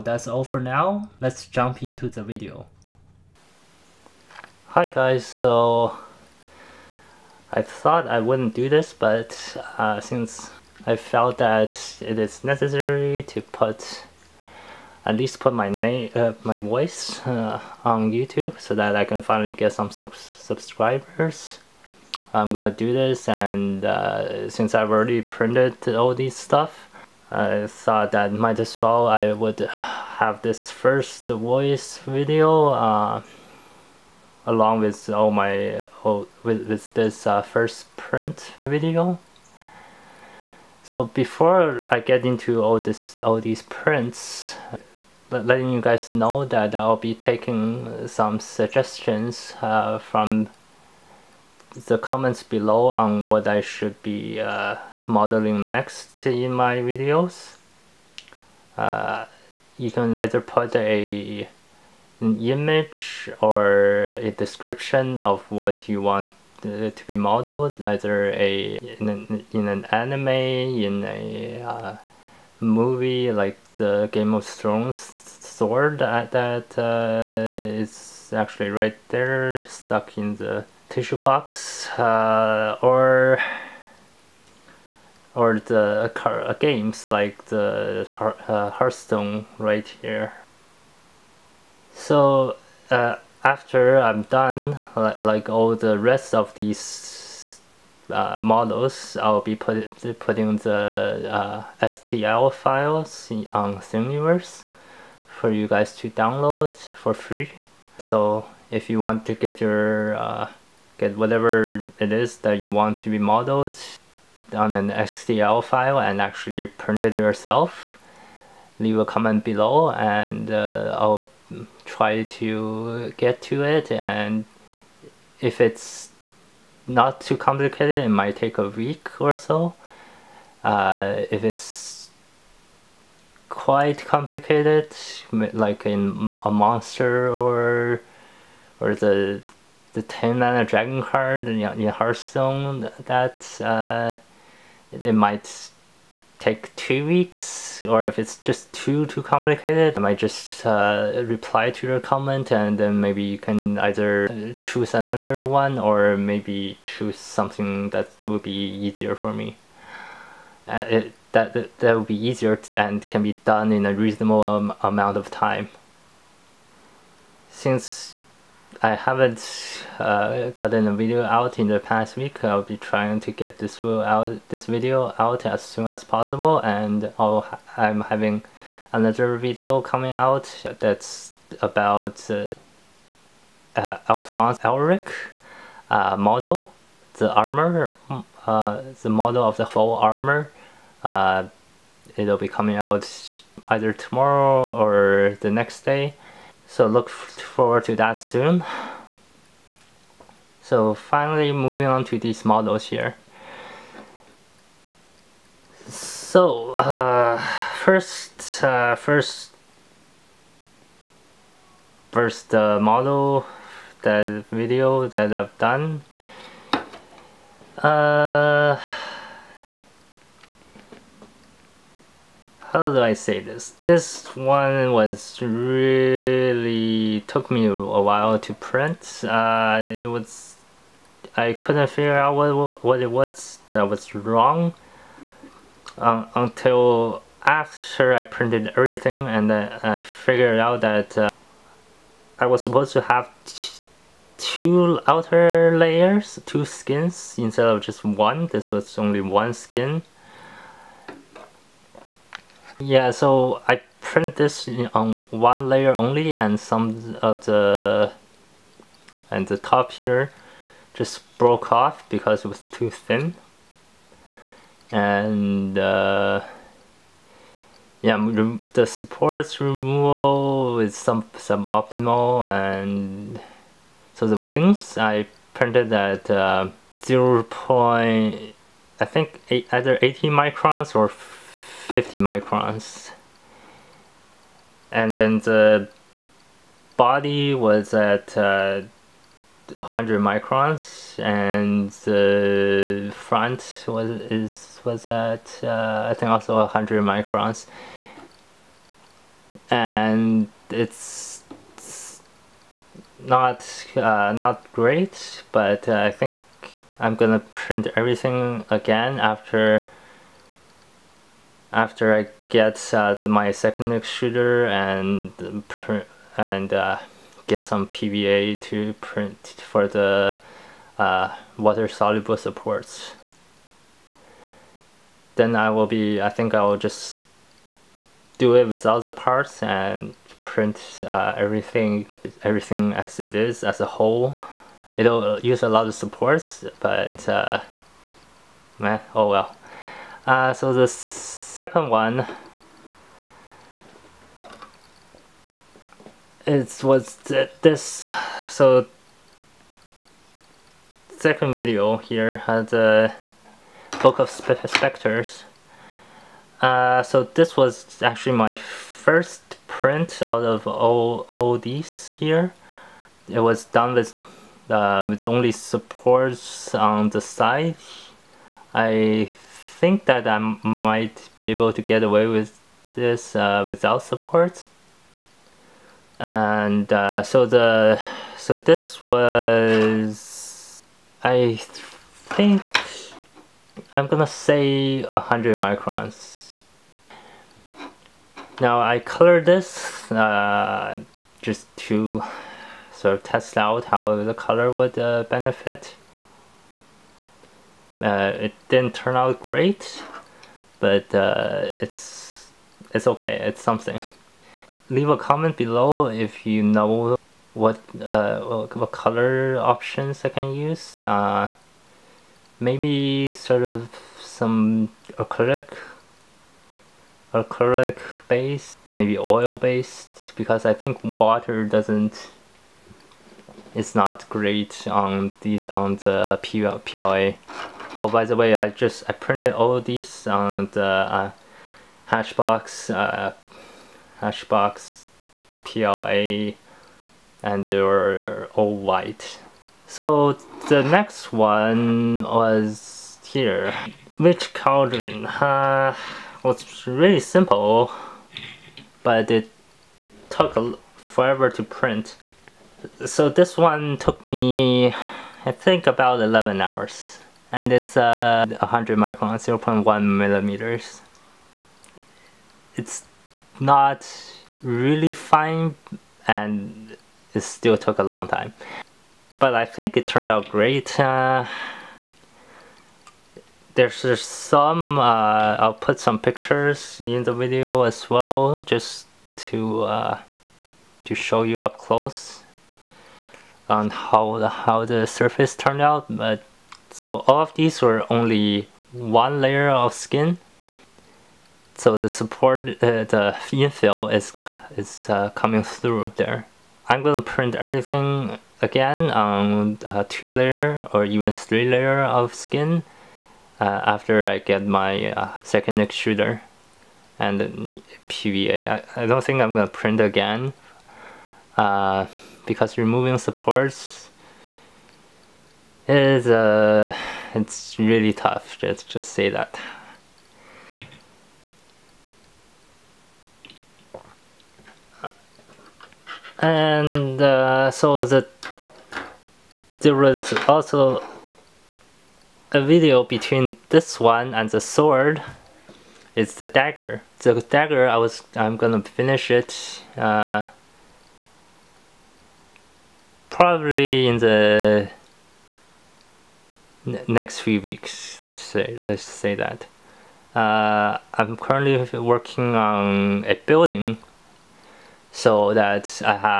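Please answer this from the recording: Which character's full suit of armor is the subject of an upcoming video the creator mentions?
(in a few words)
Alphonse Elric.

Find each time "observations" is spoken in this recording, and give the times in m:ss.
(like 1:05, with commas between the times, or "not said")
not said.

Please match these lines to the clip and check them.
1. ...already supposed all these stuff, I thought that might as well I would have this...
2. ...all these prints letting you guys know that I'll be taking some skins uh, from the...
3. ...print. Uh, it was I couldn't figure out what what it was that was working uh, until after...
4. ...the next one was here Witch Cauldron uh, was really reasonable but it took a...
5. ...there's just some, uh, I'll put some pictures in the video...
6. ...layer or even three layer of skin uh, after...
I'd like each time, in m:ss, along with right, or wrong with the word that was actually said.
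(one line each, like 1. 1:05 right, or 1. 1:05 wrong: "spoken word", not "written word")
1. 0:24 wrong: "printed", not "supposed"
2. 0:43 wrong: "suggestions", not "skins"
3. 3:48 wrong: "wrong", not "working"
4. 7:20 wrong: "simple", not "reasonable"
5. 7:53 right
6. 8:20 right.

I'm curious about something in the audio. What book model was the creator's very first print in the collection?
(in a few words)
book of specters.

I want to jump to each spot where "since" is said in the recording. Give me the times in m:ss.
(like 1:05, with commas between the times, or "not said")
0:09, 0:24, 2:47.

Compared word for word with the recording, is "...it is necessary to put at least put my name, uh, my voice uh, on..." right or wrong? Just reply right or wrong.
right.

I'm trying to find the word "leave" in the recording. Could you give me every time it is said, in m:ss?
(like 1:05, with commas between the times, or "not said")
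1:58, 6:44.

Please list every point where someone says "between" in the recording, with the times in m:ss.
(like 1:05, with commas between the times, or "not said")
8:53.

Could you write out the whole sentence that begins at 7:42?
It's not really fine and it still took a long time.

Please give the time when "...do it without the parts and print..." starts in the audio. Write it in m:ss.
5:28.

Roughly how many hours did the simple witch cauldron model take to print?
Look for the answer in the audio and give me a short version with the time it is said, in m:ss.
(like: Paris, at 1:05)
11, at 7:36.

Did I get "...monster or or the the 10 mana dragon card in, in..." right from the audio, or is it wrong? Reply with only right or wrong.
right.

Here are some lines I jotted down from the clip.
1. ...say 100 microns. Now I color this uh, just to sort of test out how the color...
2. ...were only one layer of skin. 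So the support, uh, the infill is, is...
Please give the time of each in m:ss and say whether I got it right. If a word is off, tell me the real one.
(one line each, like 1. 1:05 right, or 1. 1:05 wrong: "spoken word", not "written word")
1. 6:24 right
2. 8:07 right.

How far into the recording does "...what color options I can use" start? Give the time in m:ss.
6:48.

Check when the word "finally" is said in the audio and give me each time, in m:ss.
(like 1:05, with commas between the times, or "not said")
0:19, 3:20.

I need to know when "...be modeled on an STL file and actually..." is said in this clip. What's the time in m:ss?
1:53.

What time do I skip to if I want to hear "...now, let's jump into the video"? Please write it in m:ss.
0:00.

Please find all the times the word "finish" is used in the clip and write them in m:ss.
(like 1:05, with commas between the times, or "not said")
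8:58.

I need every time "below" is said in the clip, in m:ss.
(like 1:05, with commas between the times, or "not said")
0:52, 1:59, 6:45.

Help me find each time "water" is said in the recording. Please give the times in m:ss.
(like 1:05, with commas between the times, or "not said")
5:21, 7:01.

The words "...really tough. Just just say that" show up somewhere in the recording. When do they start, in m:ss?
8:37.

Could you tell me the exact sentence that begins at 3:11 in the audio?
Uh, it'll be coming out either tomorrow or the next day.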